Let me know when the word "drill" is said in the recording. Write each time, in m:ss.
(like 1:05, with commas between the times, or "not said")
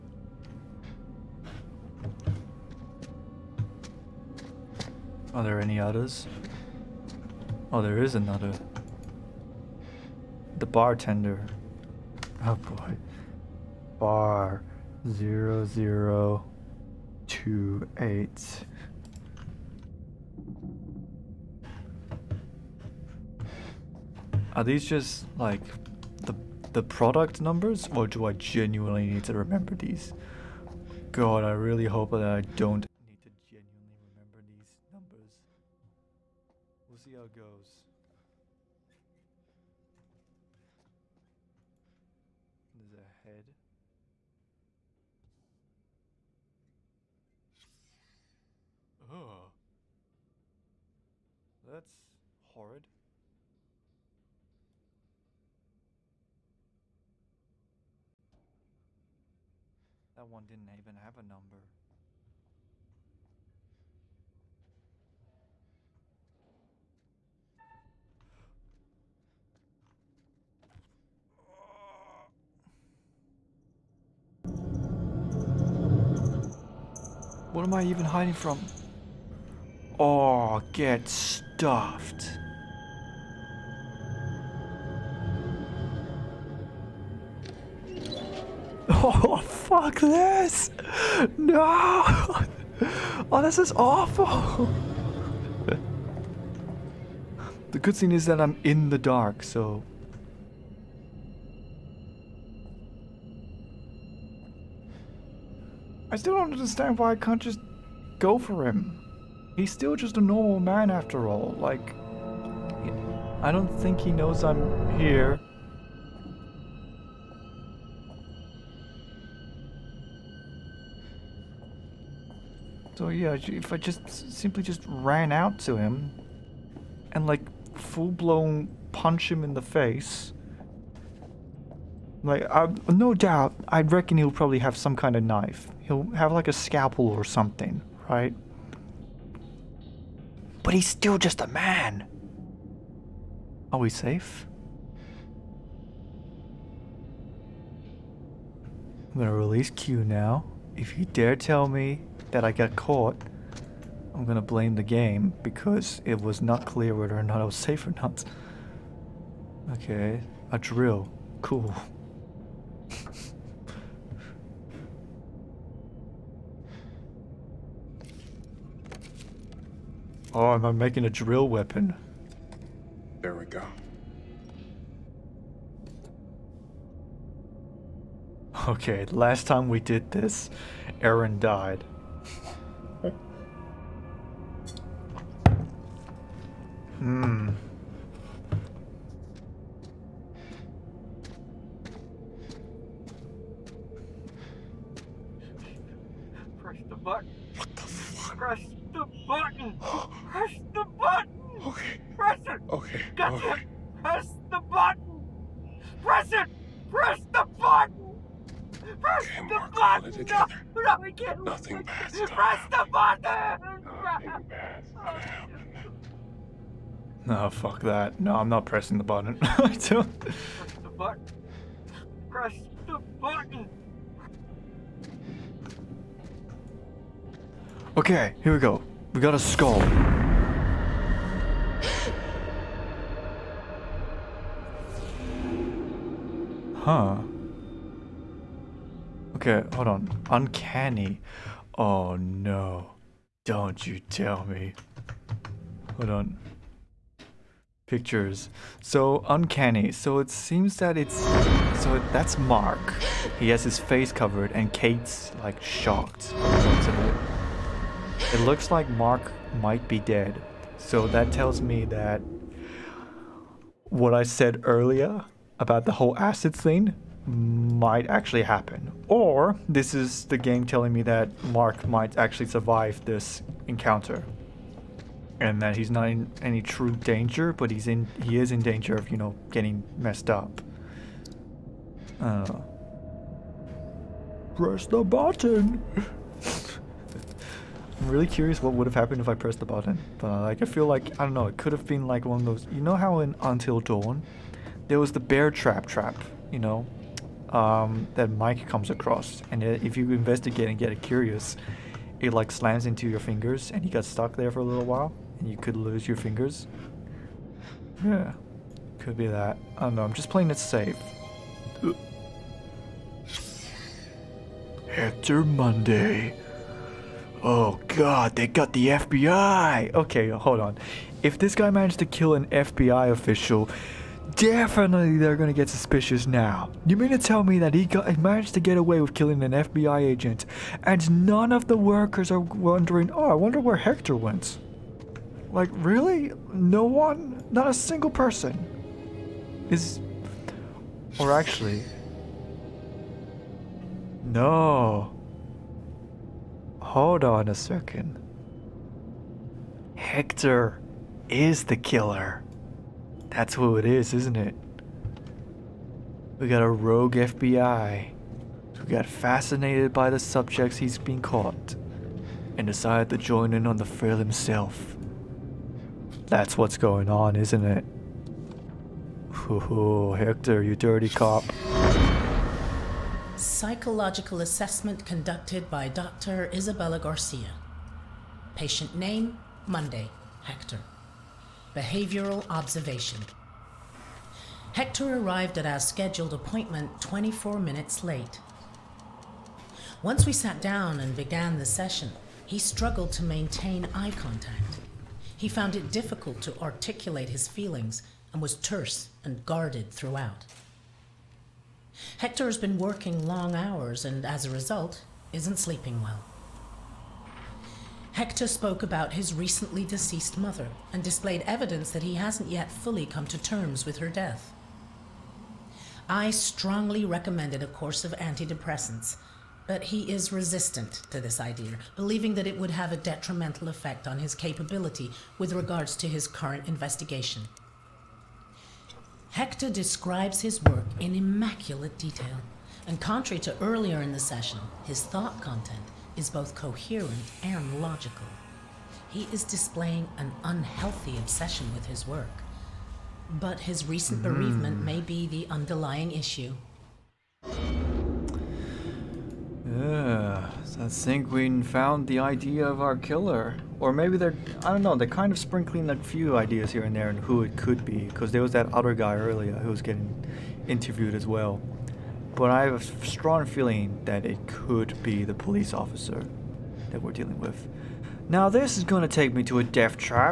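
2:40, 2:51.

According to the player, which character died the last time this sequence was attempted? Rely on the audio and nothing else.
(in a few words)
Erin.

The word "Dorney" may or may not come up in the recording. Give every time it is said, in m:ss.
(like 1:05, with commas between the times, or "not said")
not said.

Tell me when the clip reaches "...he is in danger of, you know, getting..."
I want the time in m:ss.
4:38.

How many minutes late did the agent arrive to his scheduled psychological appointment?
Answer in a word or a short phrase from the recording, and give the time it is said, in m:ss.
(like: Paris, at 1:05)
24, at 6:27.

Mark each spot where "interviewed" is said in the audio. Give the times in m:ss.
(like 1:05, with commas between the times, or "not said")
7:40.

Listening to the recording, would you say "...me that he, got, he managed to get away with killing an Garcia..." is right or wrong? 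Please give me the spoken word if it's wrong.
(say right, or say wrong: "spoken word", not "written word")
wrong: "FBI", not "Garcia".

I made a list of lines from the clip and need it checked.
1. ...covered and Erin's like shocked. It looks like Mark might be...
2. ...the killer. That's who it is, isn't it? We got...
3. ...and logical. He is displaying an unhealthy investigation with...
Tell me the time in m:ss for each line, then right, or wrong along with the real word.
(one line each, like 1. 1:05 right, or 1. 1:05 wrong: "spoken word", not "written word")
1. 4:14 wrong: "Kate", not "Erin"
2. 5:51 right
3. 7:17 wrong: "obsession", not "investigation".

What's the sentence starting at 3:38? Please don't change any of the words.
No, I'm not pressing the button.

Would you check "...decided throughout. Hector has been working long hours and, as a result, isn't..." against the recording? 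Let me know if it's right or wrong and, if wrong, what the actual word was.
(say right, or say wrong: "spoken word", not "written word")
wrong: "guarded", not "decided".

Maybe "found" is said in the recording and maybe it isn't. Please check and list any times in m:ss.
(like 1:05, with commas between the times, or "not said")
6:35, 7:31.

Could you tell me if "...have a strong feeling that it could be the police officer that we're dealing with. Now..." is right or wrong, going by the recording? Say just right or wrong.
right.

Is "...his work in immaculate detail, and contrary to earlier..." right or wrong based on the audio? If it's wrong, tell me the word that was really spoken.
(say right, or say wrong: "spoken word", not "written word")
right.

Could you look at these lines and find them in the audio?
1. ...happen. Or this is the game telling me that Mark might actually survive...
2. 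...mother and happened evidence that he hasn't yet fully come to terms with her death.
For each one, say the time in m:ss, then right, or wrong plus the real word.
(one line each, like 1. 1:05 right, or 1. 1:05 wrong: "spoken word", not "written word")
1. 4:28 right
2. 6:50 wrong: "displayed", not "happened".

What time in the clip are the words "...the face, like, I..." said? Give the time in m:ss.
2:09.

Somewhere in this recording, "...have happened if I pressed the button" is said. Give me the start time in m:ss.
4:48.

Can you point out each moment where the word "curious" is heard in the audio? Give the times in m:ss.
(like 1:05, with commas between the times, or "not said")
4:48, 5:01.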